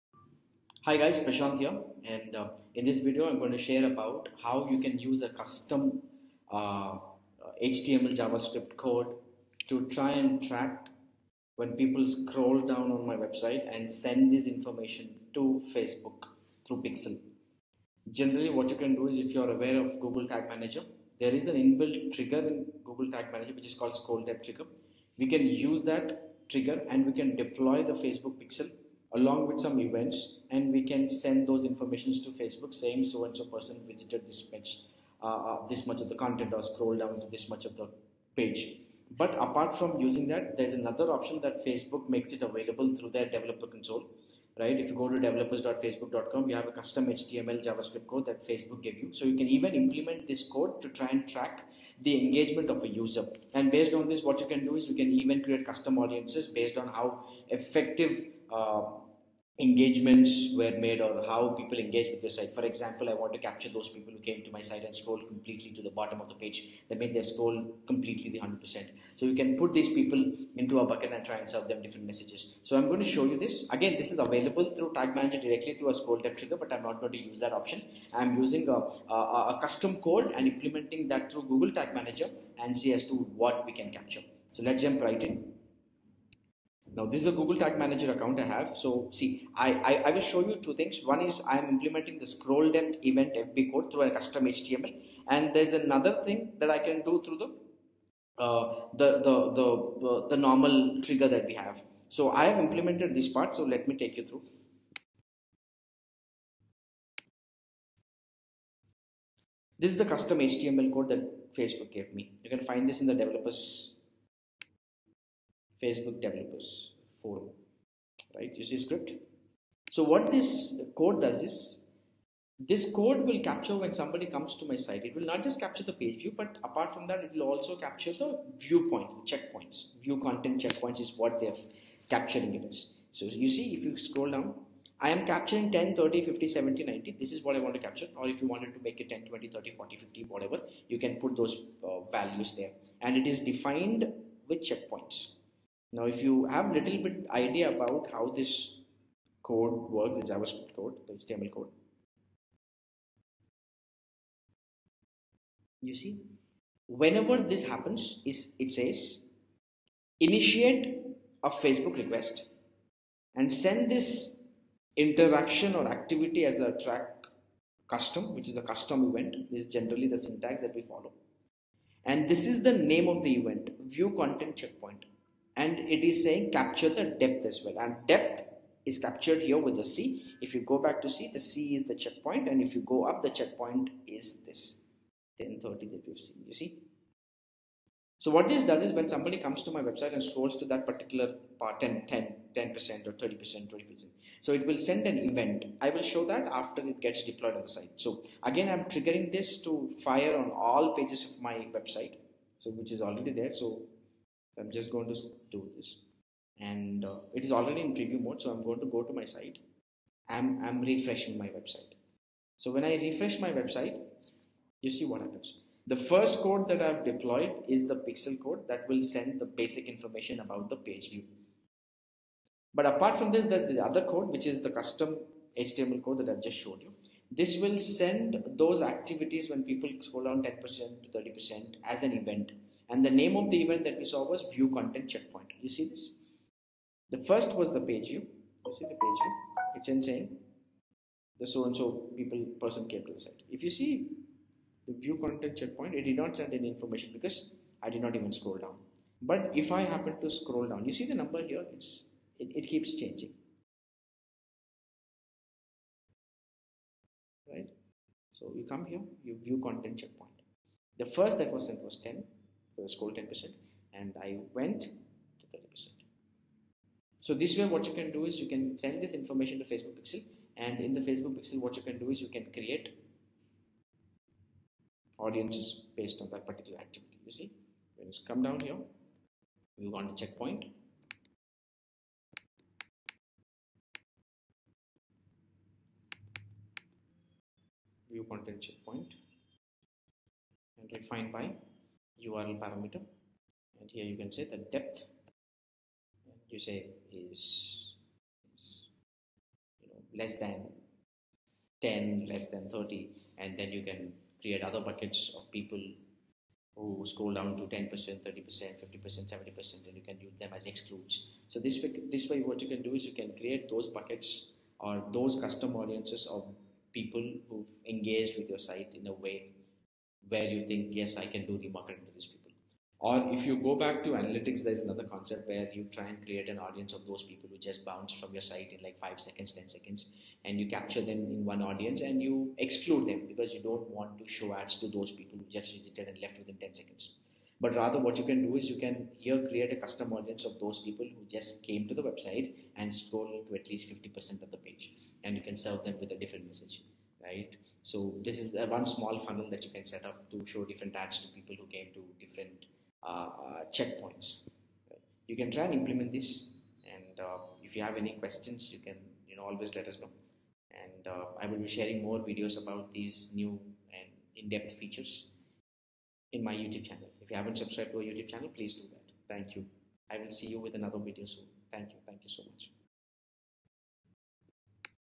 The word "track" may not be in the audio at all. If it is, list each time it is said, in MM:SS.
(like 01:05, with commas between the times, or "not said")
00:10, 00:51, 02:46.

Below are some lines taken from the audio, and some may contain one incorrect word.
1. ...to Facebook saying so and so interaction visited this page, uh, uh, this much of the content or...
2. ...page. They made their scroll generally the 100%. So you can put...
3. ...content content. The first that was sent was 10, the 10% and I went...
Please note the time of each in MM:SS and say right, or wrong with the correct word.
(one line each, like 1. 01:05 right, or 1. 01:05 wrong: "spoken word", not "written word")
1. 00:32 wrong: "person", not "interaction"
2. 01:06 wrong: "completely", not "generally"
3. 04:19 wrong: "checkpoint", not "content".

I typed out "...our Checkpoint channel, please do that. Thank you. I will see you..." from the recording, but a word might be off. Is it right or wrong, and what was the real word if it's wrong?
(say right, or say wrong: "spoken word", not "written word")
wrong: "YouTube", not "Checkpoint".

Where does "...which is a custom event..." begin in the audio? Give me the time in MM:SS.
02:48.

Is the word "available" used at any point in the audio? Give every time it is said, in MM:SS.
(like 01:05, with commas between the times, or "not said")
00:42, 01:14.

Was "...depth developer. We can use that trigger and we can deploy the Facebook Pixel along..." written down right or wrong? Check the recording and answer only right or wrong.
wrong.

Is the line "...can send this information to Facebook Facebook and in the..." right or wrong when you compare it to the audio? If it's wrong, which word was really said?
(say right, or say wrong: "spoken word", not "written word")
wrong: "Pixel", not "Facebook".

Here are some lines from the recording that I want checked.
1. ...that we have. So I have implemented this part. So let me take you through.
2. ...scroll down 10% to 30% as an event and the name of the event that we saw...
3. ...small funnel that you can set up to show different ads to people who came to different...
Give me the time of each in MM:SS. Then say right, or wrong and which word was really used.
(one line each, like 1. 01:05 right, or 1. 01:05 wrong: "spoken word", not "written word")
1. 01:41 right
2. 03:50 right
3. 05:48 right.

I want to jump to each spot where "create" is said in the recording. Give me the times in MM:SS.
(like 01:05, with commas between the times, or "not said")
00:55, 04:32, 05:04, 05:13, 05:26, 05:39.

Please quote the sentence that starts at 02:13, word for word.
So you see, if you scroll down, I am capturing 10, 30, 50, 70, 90.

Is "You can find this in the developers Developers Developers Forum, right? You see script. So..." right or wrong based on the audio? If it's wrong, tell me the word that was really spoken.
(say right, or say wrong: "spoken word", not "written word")
wrong: "Facebook", not "Developers".